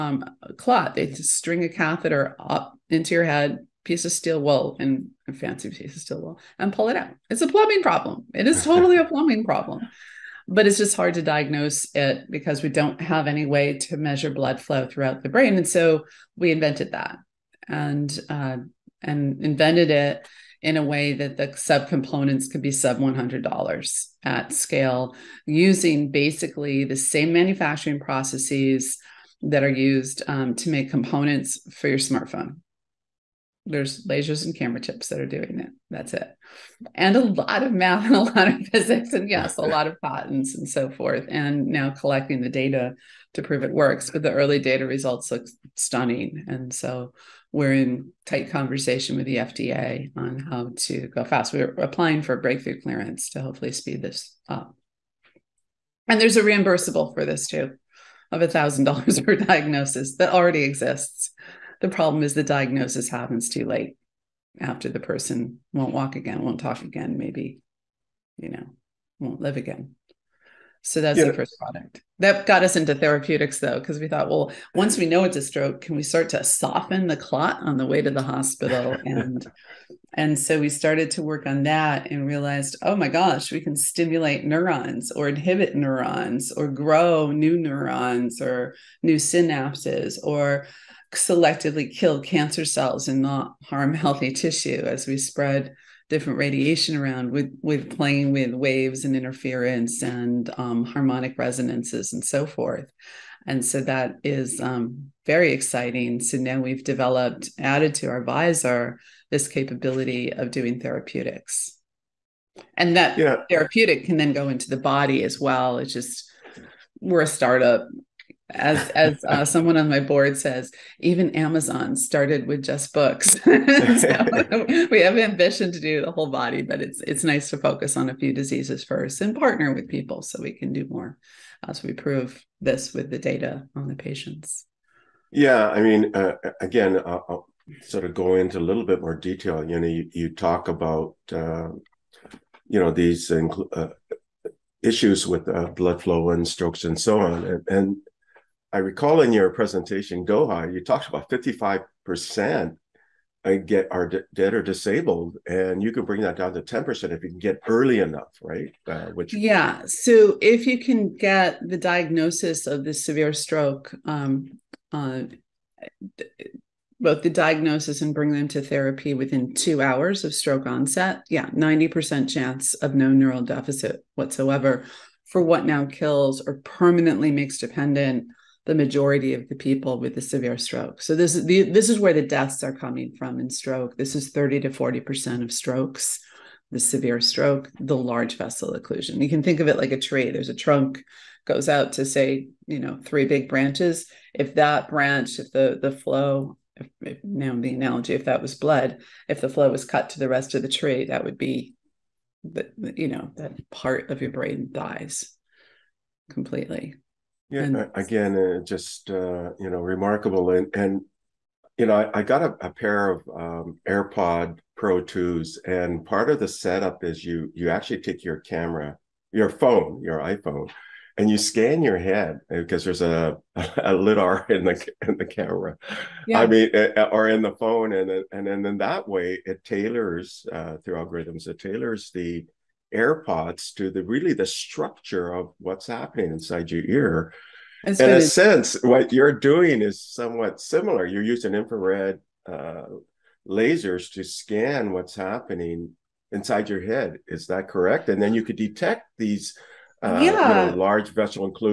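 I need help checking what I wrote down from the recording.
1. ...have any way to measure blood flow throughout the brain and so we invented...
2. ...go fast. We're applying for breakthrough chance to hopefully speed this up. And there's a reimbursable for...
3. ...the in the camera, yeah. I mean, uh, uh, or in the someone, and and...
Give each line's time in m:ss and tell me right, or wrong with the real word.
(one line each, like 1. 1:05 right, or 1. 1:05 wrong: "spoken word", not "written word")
1. 0:13 right
2. 0:51 wrong: "clearance", not "chance"
3. 3:44 wrong: "phone", not "someone".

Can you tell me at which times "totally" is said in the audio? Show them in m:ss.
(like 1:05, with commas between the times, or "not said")
0:08.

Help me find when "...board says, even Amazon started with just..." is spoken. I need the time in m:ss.
2:00.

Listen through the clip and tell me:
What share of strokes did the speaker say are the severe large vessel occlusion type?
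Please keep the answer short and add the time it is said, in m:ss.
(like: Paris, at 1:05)
30 to 40%, at 3:04.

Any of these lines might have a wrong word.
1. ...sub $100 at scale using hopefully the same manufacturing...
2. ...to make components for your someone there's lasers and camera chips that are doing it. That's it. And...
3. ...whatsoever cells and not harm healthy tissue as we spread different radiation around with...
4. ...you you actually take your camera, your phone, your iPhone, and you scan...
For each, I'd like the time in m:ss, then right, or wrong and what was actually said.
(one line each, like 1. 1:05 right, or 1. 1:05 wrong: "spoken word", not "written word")
1. 0:22 wrong: "basically", not "hopefully"
2. 0:30 wrong: "smartphone", not "someone"
3. 1:32 wrong: "cancer", not "whatsoever"
4. 3:37 right.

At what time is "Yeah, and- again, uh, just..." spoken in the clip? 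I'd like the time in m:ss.
3:27.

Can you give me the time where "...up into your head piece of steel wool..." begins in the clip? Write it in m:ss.
0:02.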